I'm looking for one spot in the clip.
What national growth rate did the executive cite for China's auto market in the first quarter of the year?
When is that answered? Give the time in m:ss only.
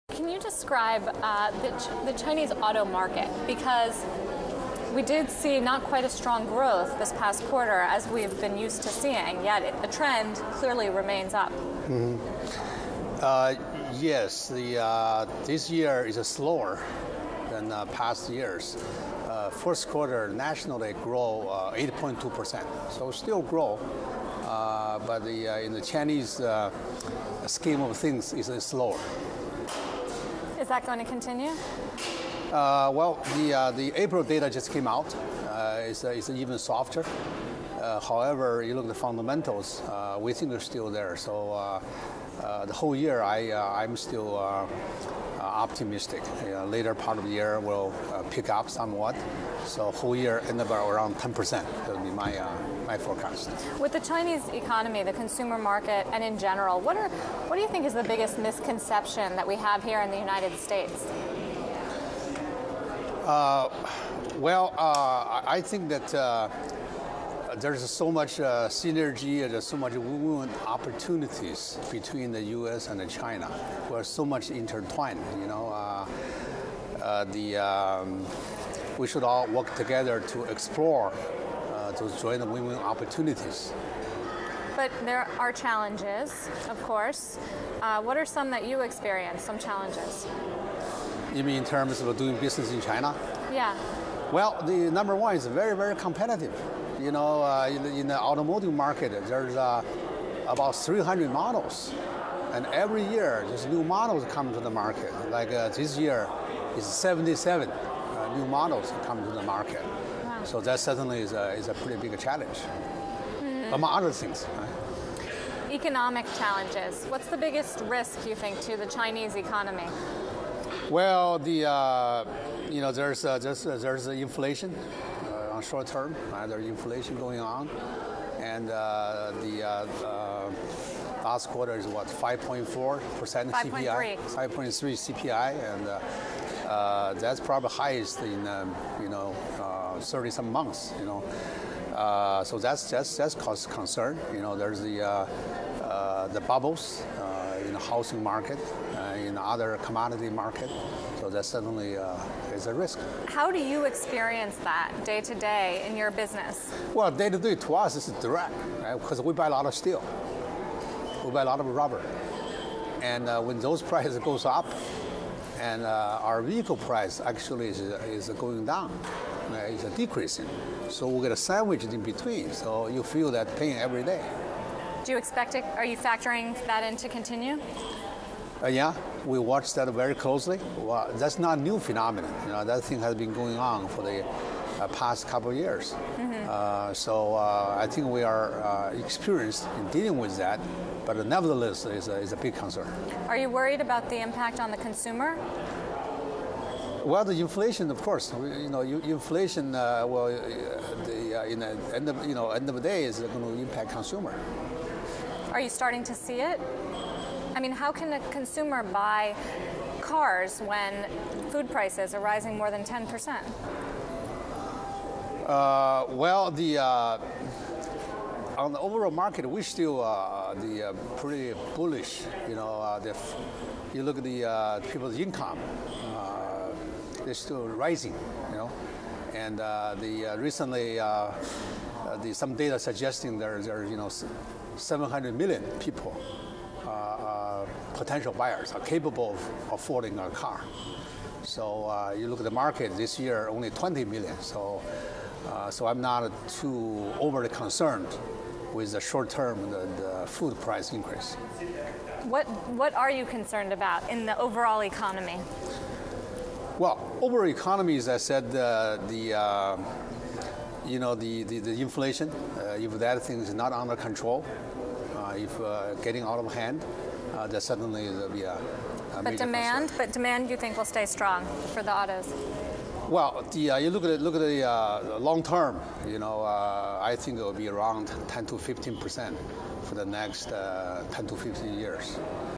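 0:21.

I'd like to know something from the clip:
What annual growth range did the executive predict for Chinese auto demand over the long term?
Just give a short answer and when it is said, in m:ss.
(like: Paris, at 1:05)
10 to 15 percent, at 4:38.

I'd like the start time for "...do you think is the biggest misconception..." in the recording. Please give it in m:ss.
0:57.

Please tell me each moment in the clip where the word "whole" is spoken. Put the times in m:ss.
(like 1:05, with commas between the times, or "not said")
0:42, 0:49.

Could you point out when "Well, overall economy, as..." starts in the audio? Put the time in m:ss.
4:16.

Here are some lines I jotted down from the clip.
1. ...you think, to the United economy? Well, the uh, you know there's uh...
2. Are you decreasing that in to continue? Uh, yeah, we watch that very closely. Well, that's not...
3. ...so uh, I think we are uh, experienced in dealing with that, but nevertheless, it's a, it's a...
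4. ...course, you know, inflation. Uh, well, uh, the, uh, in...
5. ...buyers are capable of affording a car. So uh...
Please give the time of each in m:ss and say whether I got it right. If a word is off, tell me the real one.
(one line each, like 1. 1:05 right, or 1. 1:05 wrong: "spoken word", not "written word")
1. 1:58 wrong: "Chinese", not "United"
2. 2:55 wrong: "factoring", not "decreasing"
3. 3:06 right
4. 3:18 right
5. 3:58 right.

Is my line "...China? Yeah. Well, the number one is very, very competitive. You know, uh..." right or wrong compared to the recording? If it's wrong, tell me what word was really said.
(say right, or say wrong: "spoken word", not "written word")
right.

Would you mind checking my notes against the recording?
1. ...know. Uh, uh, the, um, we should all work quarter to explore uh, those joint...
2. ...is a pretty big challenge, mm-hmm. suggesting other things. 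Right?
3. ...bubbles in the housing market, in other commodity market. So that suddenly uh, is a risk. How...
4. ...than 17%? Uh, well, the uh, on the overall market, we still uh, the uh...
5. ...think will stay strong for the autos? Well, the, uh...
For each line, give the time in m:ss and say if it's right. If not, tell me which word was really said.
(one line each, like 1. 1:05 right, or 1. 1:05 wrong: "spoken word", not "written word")
1. 1:15 wrong: "together", not "quarter"
2. 1:51 wrong: "among", not "suggesting"
3. 2:26 right
4. 3:32 wrong: "10", not "17"
5. 4:30 right.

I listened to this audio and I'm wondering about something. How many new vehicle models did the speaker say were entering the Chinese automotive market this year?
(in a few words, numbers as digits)
77.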